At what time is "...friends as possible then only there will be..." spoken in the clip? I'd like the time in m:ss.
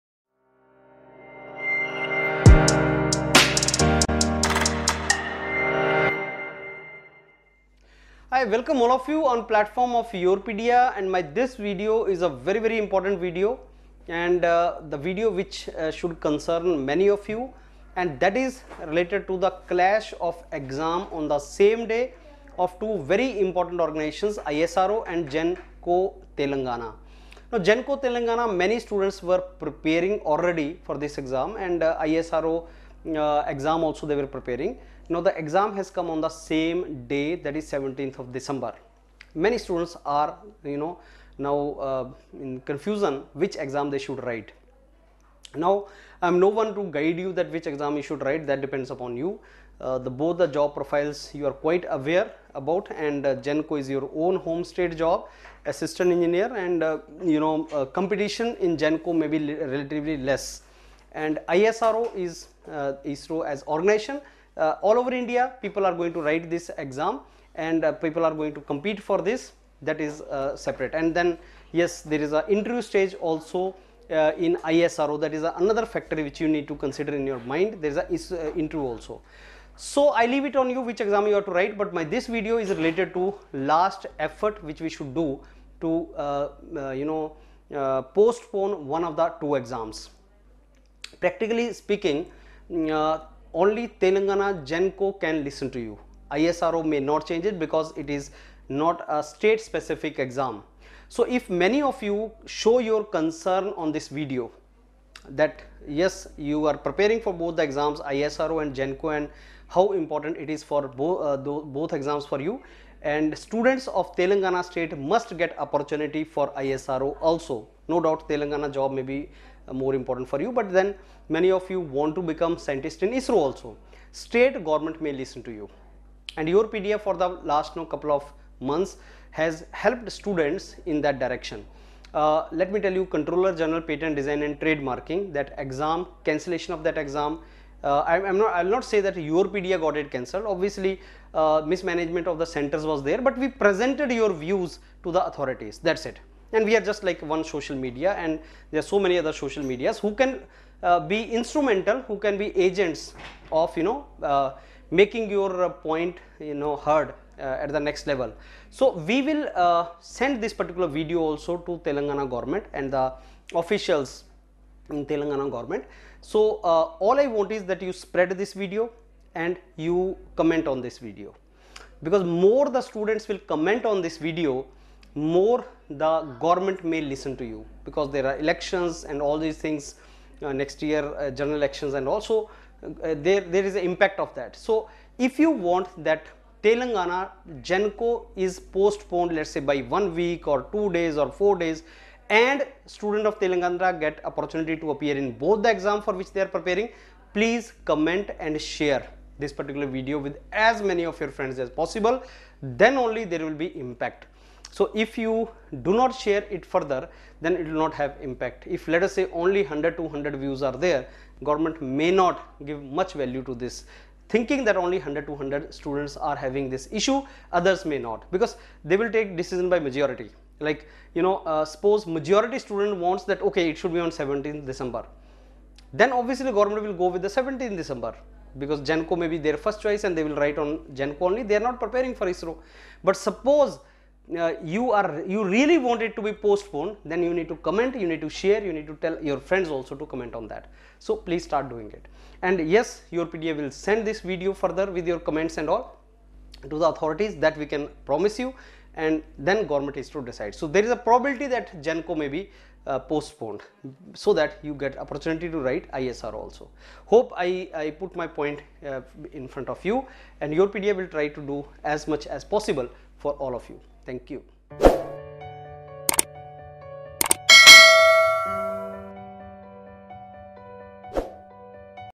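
3:21.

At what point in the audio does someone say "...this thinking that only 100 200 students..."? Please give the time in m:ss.
3:33.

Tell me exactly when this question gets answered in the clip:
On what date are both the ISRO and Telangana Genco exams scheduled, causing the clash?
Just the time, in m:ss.
0:37.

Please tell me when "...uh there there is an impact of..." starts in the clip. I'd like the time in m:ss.
3:03.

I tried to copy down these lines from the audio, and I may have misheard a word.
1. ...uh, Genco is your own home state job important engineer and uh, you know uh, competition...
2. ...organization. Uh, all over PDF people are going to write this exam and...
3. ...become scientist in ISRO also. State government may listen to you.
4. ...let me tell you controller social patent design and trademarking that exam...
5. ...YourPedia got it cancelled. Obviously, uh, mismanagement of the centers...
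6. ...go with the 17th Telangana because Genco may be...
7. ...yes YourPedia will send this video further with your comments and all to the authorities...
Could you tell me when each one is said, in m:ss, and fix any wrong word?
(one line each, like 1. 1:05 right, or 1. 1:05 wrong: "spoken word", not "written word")
1. 0:53 wrong: "assistant", not "important"
2. 1:03 wrong: "India", not "PDF"
3. 2:02 right
4. 2:12 wrong: "general", not "social"
5. 2:19 right
6. 3:47 wrong: "December", not "Telangana"
7. 4:02 right.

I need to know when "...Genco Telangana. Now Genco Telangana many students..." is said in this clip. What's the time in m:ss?
0:25.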